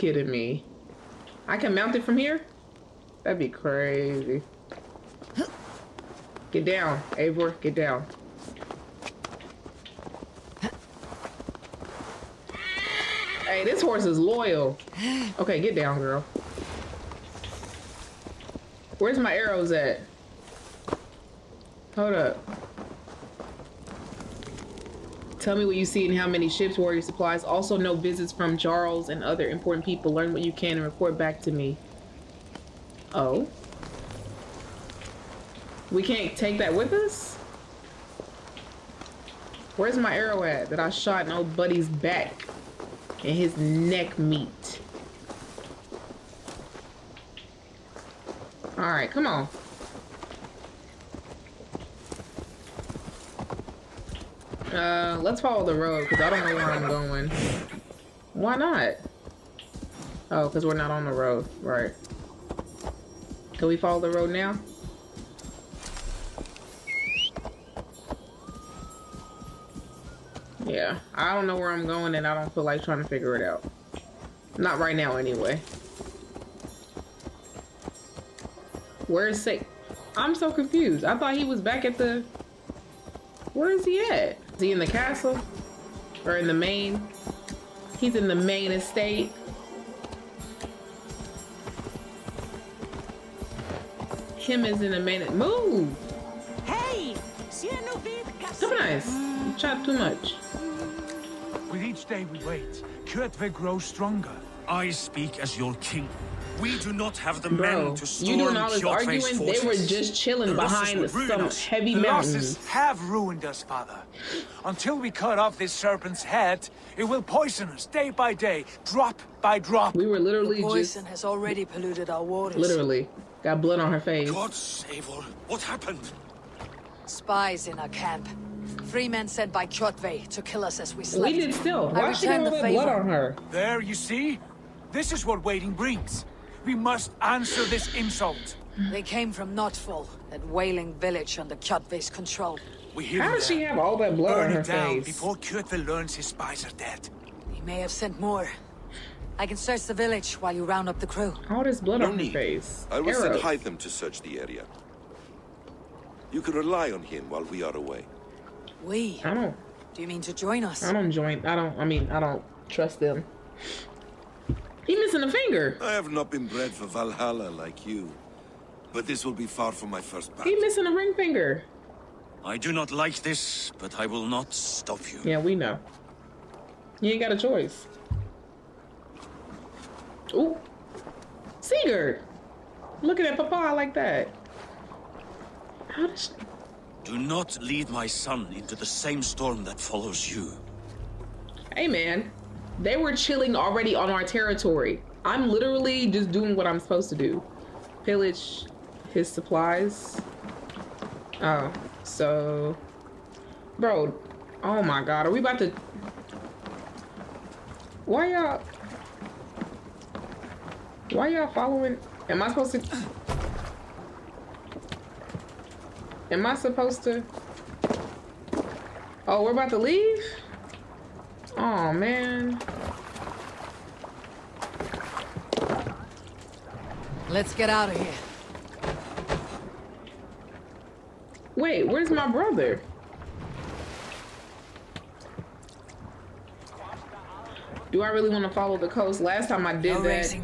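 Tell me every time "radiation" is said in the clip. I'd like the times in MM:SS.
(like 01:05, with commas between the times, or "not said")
not said.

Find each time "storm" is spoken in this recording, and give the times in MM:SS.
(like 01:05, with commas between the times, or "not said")
01:48, 03:09.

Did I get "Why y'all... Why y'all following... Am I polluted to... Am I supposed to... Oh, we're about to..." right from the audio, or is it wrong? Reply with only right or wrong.
wrong.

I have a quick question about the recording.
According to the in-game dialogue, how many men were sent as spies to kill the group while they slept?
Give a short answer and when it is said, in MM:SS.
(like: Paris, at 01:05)
3, at 02:08.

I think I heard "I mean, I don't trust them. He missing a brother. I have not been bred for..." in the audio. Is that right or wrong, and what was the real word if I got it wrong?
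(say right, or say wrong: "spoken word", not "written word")
wrong: "finger", not "brother".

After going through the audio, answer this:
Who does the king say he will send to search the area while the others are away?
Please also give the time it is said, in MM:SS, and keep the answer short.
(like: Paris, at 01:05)
Hytham, at 02:33.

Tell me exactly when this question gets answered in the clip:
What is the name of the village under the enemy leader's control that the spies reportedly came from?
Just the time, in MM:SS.
02:19.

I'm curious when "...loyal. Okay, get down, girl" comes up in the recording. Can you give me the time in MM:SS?
00:14.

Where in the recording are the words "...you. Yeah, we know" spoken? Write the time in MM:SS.
02:55.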